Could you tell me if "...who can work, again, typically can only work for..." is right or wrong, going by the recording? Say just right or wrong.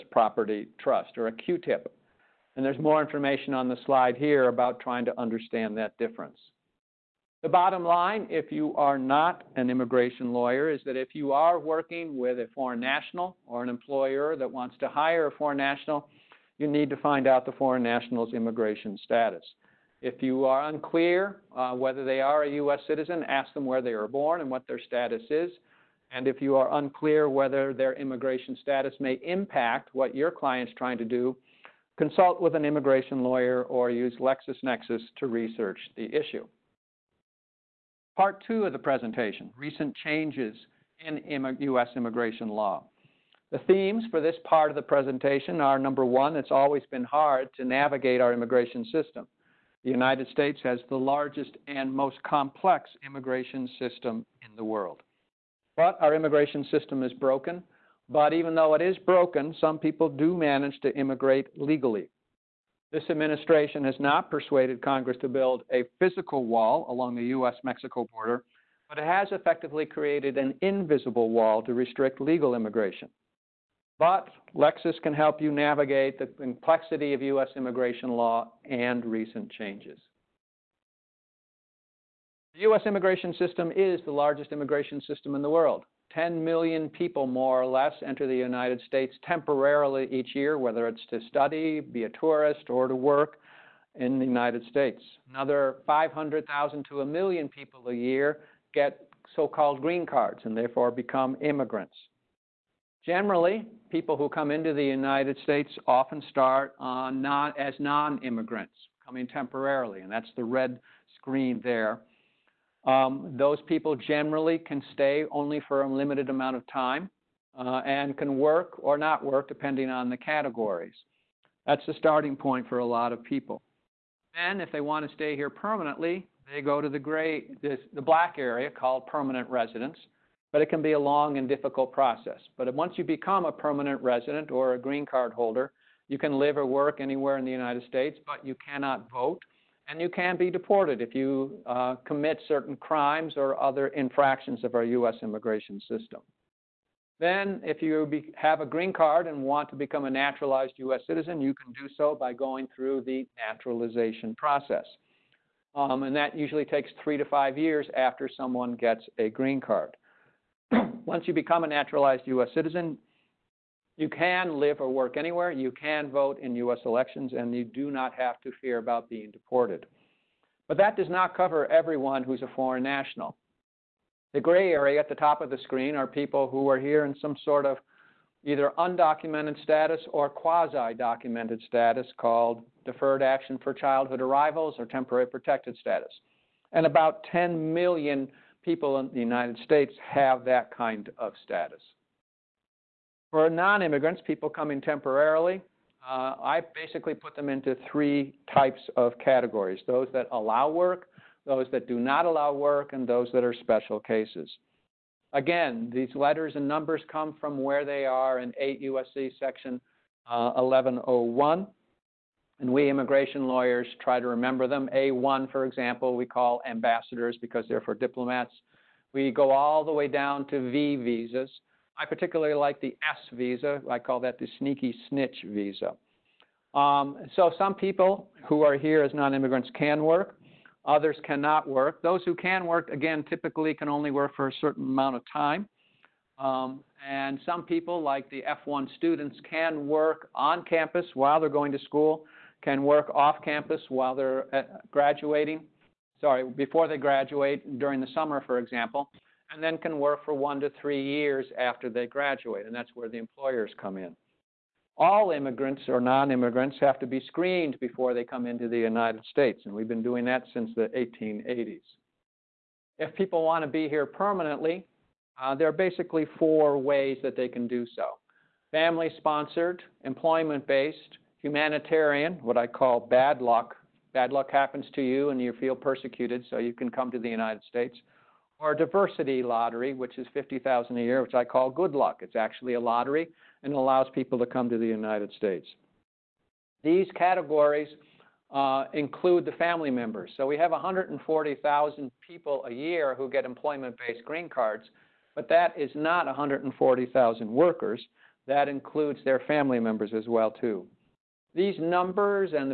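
right.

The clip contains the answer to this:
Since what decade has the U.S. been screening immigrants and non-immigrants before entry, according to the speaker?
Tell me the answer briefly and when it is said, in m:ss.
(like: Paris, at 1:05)
1880s, at 4:20.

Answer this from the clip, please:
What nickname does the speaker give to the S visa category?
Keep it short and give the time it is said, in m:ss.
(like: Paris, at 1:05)
sneaky snitch visa, at 3:44.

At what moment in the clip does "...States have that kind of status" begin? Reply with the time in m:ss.
3:09.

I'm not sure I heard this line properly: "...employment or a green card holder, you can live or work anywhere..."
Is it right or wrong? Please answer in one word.
wrong.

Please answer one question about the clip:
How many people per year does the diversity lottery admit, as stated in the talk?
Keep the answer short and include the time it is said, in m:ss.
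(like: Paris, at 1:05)
50,000, at 4:40.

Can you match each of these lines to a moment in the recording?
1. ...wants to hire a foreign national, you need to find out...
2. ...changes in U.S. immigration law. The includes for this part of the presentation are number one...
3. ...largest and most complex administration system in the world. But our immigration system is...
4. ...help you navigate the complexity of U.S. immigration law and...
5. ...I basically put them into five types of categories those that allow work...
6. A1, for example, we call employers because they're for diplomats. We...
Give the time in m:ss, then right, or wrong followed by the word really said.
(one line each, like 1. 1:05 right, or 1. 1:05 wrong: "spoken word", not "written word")
1. 0:14 right
2. 0:40 wrong: "themes", not "includes"
3. 0:50 wrong: "immigration", not "administration"
4. 1:15 right
5. 3:16 wrong: "three", not "five"
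6. 3:34 wrong: "ambassadors", not "employers".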